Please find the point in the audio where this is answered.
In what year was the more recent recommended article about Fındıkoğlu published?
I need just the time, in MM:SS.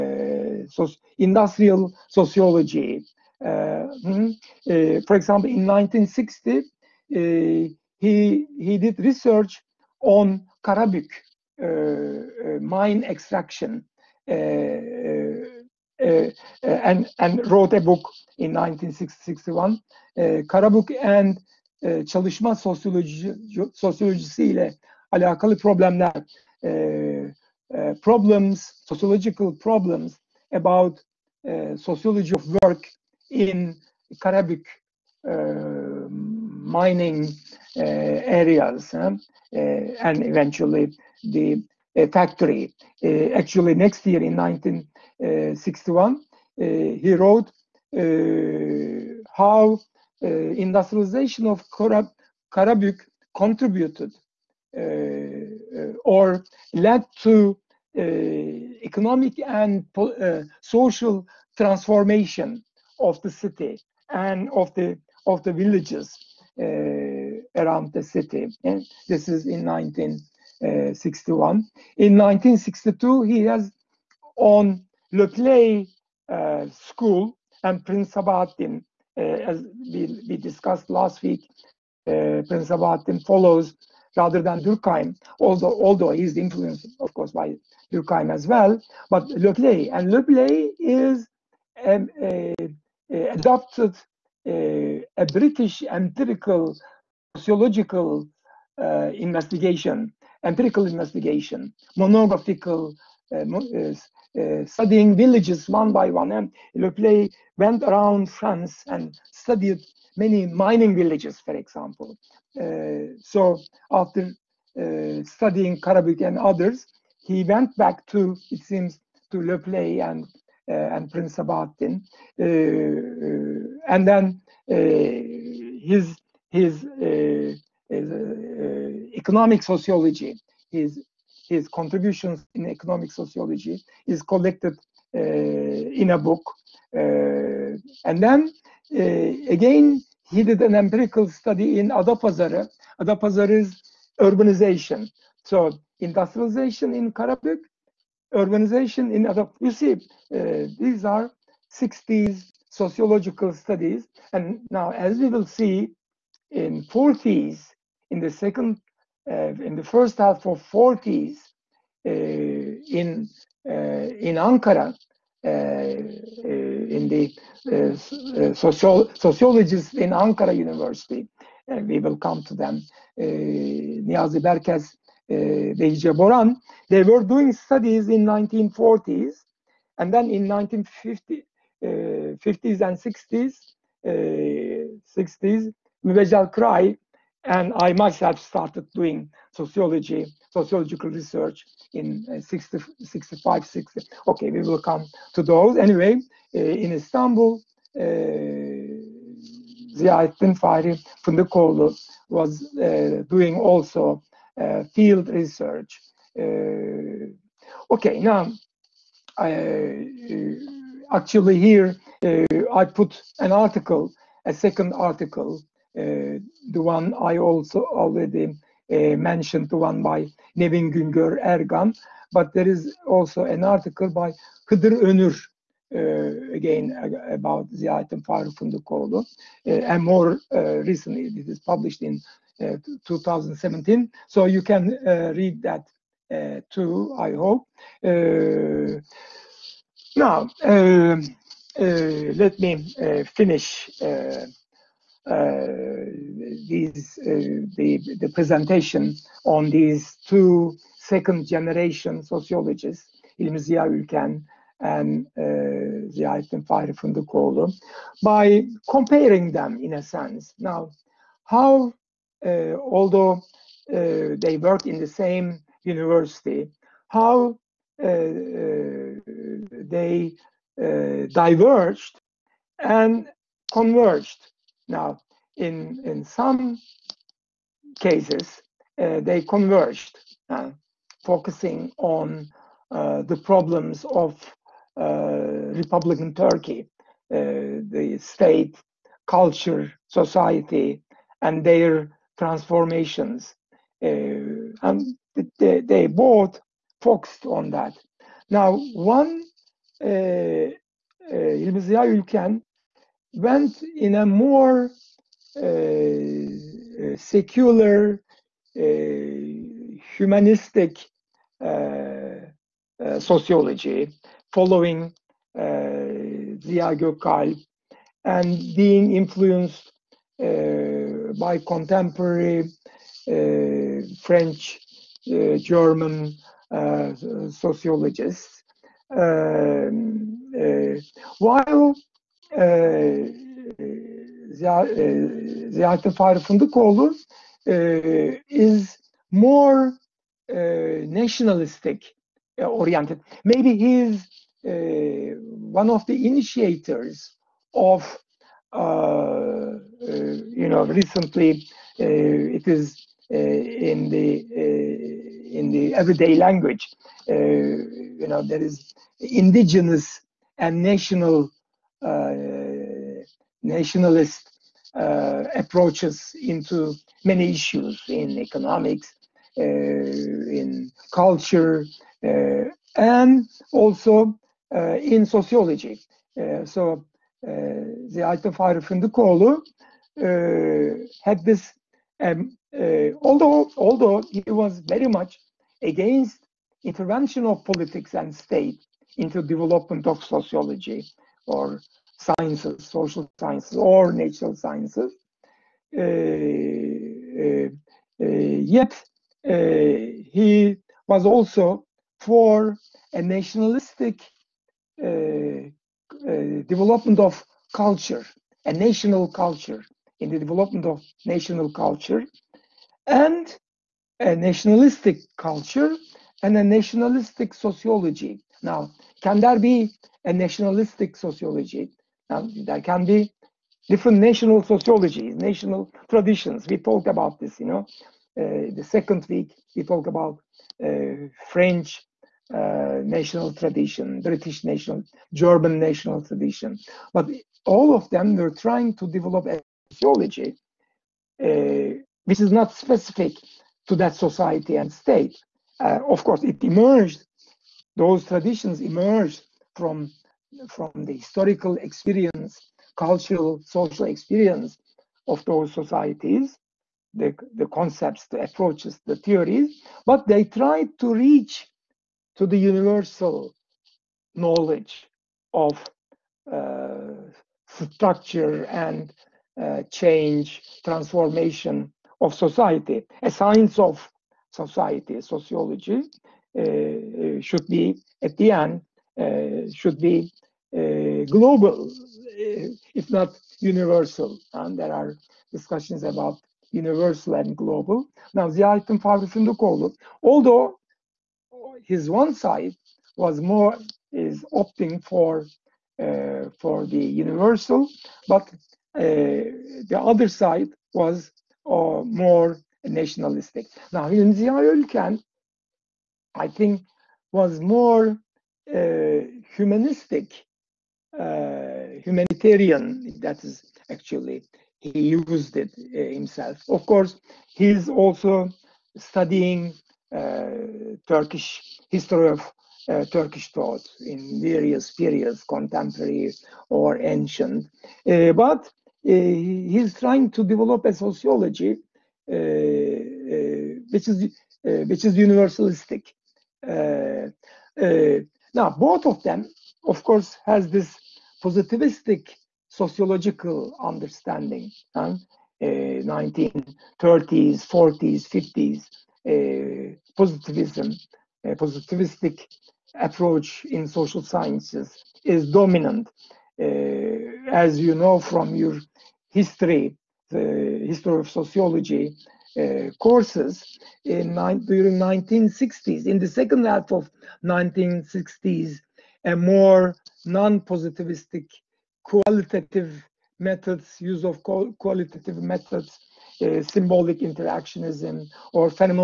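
03:53.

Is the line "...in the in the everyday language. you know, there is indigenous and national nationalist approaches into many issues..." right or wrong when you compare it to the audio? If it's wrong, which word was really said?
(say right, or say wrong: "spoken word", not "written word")
right.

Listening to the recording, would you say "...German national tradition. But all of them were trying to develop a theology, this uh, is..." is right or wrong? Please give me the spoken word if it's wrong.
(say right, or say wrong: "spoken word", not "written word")
right.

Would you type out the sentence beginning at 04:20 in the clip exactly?
Now, how uh, although uh, they worked in the same university, how uh, they diverged and converged.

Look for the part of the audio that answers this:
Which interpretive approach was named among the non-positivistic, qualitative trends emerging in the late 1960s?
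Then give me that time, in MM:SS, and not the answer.
09:36.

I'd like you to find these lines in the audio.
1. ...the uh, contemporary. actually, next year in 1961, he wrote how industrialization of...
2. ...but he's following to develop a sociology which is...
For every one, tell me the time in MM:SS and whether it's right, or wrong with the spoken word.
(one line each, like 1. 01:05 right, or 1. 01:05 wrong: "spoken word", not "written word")
1. 00:41 wrong: "factory", not "contemporary"
2. 08:48 wrong: "trying", not "following".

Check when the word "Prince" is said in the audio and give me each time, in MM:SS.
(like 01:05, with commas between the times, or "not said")
01:17, 01:22, 02:01.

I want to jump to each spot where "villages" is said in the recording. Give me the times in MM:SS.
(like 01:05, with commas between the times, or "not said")
01:05, 01:45, 01:50.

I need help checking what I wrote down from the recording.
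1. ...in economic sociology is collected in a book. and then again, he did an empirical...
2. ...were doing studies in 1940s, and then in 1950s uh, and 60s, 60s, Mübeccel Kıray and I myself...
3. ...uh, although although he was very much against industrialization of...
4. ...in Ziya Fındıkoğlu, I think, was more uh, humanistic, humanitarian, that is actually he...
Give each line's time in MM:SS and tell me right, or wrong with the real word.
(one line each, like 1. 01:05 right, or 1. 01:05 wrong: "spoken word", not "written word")
1. 02:12 right
2. 02:57 right
3. 06:22 wrong: "intervention", not "industrialization"
4. 08:24 wrong: "Ülken", not "Fındıkoğlu".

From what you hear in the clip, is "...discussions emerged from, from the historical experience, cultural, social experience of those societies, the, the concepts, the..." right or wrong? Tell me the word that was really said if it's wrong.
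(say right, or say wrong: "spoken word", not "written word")
wrong: "traditions", not "discussions".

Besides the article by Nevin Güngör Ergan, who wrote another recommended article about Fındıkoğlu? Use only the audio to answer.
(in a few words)
Hıdır Önür.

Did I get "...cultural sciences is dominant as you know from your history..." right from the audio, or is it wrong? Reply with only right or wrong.
wrong.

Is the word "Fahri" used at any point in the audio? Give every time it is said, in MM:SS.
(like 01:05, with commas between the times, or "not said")
03:20, 04:16, 05:36, 08:09.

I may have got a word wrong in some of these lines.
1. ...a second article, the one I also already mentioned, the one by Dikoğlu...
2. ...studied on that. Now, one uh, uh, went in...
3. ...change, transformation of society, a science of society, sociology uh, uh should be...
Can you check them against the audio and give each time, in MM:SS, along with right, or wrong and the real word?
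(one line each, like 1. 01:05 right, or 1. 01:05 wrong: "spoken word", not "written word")
1. 03:34 wrong: "Nevin", not "Dikoğlu"
2. 04:57 wrong: "focused", not "studied"
3. 07:49 right.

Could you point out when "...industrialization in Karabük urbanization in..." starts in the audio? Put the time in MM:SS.
02:26.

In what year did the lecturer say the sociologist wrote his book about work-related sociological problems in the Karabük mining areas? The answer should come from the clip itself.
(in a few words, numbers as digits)
1961.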